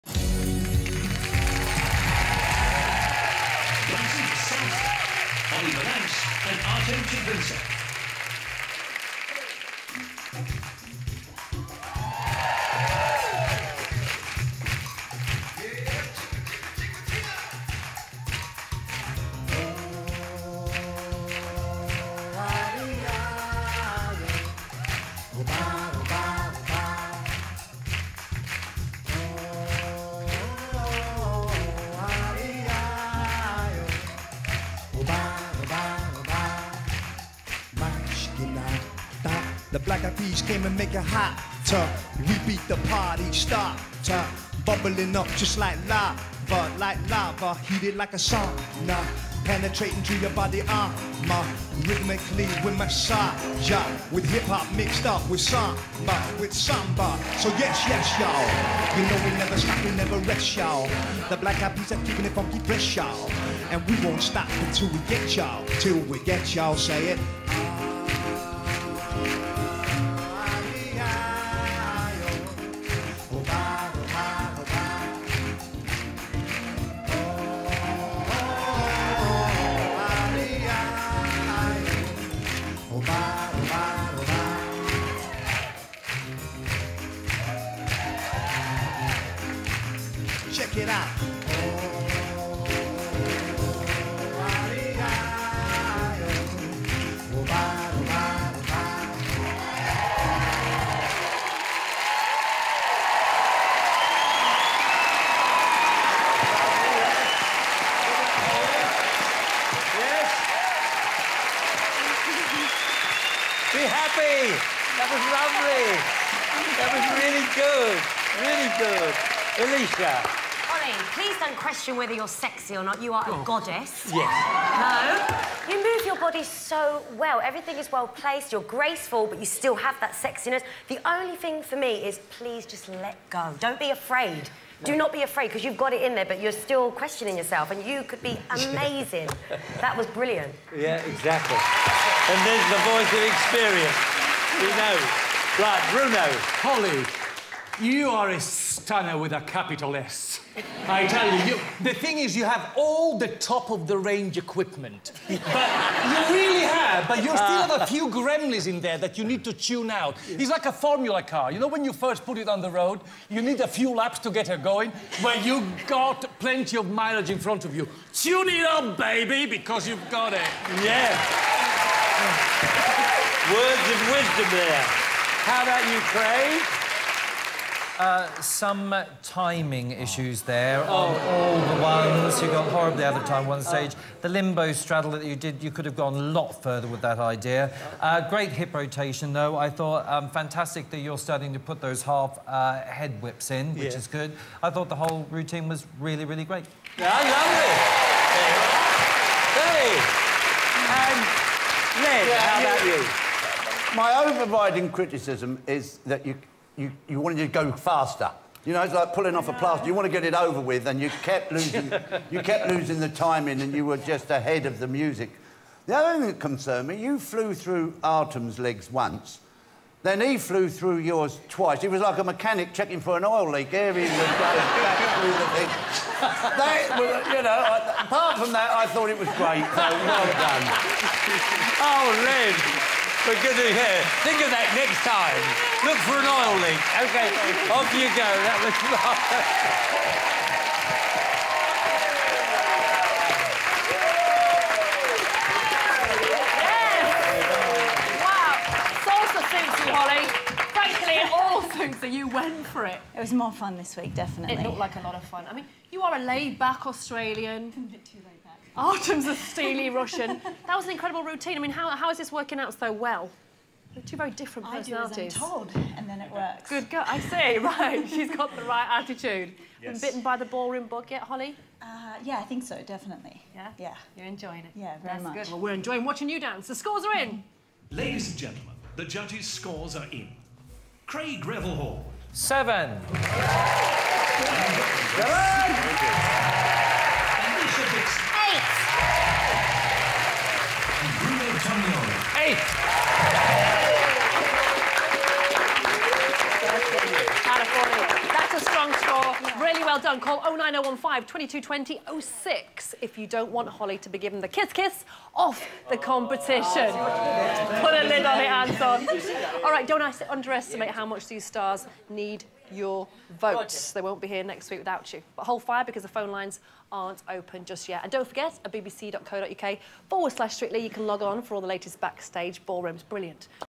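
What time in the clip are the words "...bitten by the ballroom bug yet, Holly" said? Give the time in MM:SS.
04:30.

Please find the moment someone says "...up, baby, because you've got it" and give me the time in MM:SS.
02:48.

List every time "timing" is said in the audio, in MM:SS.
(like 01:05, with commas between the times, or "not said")
02:59, 03:33.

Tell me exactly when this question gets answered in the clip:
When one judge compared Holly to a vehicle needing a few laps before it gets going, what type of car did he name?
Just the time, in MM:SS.
02:40.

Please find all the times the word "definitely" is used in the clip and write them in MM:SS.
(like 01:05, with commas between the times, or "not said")
04:14, 04:32.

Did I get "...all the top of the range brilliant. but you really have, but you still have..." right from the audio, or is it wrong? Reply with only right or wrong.
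wrong.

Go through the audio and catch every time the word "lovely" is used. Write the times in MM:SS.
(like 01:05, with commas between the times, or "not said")
01:55, 03:17.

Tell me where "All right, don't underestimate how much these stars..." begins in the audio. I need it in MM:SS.
05:09.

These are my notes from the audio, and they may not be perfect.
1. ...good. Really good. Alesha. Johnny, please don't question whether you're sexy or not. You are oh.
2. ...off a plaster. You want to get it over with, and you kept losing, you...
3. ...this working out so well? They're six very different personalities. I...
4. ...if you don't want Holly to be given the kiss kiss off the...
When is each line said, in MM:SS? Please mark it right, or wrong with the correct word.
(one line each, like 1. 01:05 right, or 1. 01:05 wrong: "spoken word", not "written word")
1. 01:57 right
2. 03:29 right
3. 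04:22 wrong: "two", not "six"
4. 05:03 right.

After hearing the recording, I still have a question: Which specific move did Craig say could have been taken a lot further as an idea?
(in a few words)
limbo straddle.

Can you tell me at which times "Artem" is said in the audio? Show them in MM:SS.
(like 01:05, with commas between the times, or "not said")
03:38, 04:18.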